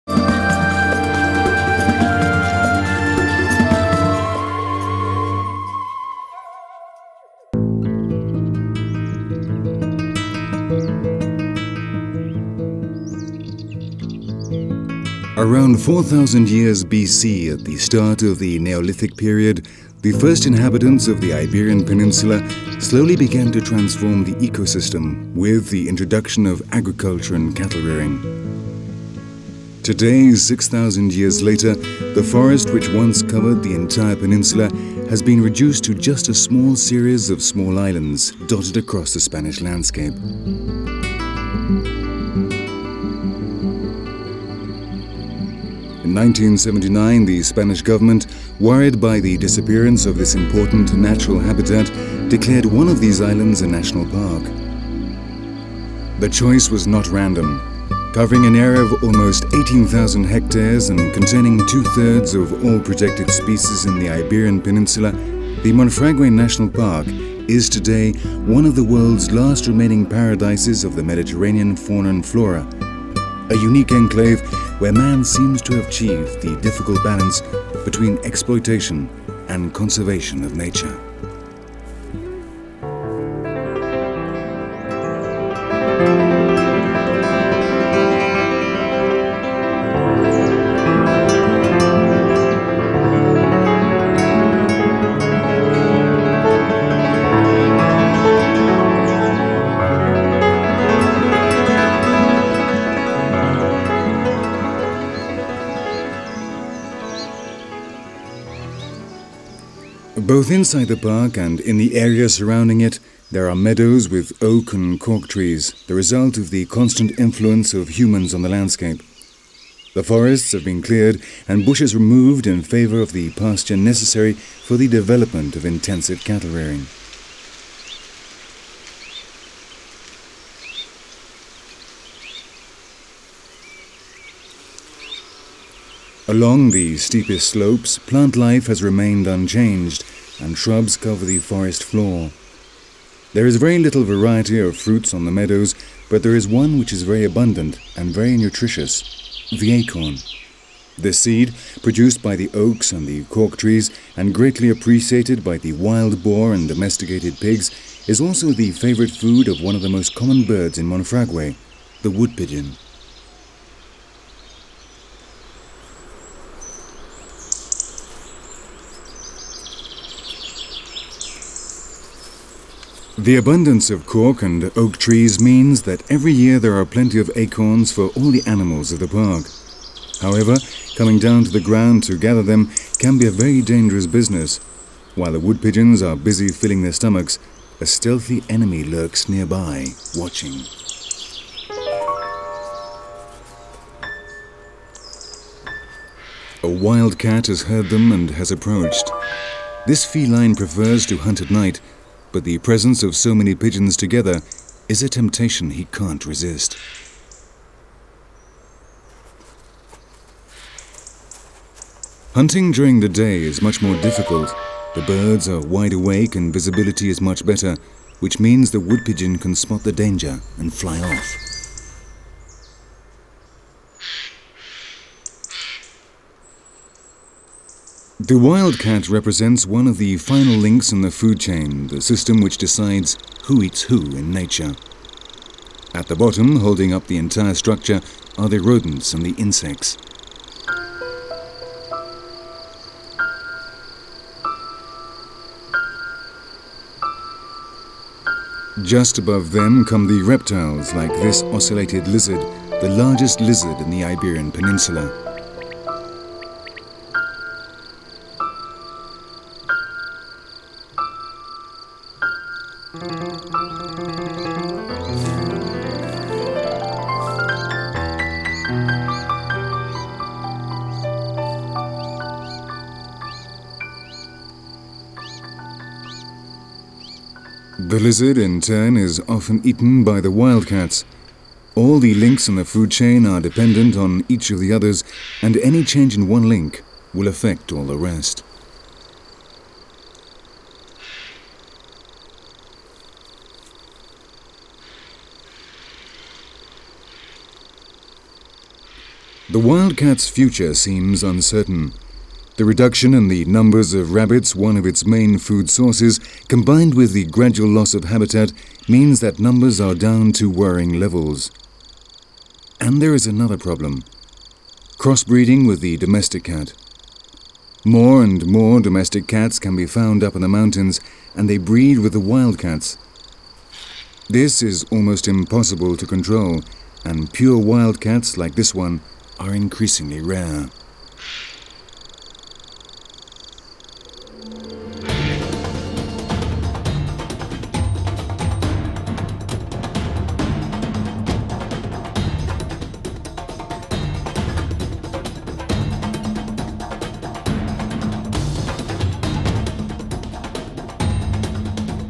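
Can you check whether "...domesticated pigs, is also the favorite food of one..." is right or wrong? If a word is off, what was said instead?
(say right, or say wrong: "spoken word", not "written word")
right.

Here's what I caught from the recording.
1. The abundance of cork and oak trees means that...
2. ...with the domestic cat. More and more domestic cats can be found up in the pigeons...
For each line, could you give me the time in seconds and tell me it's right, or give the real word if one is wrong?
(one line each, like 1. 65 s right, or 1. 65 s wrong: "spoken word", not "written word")
1. 173 s right
2. 315 s wrong: "mountains", not "pigeons".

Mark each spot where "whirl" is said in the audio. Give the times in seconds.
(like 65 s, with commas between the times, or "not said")
not said.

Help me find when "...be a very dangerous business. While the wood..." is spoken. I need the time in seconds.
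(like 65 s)
183 s.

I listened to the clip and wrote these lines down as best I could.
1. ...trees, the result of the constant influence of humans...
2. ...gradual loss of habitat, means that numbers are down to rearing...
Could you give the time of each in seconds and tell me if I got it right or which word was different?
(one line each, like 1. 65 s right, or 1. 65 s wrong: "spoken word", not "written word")
1. 115 s right
2. 307 s wrong: "worrying", not "rearing".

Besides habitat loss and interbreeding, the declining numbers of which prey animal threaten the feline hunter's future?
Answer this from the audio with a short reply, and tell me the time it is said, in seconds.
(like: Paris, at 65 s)
rabbits, at 304 s.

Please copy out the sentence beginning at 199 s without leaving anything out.
This feline prefers to hunt at night but the presence of so many pigeons together is a temptation he can't resist.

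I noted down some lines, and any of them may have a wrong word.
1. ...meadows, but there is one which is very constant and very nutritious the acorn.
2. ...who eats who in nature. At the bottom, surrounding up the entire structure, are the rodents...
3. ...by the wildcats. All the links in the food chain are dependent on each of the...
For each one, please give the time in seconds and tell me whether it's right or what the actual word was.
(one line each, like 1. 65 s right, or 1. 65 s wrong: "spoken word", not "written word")
1. 145 s wrong: "abundant", not "constant"
2. 233 s wrong: "holding", not "surrounding"
3. 280 s right.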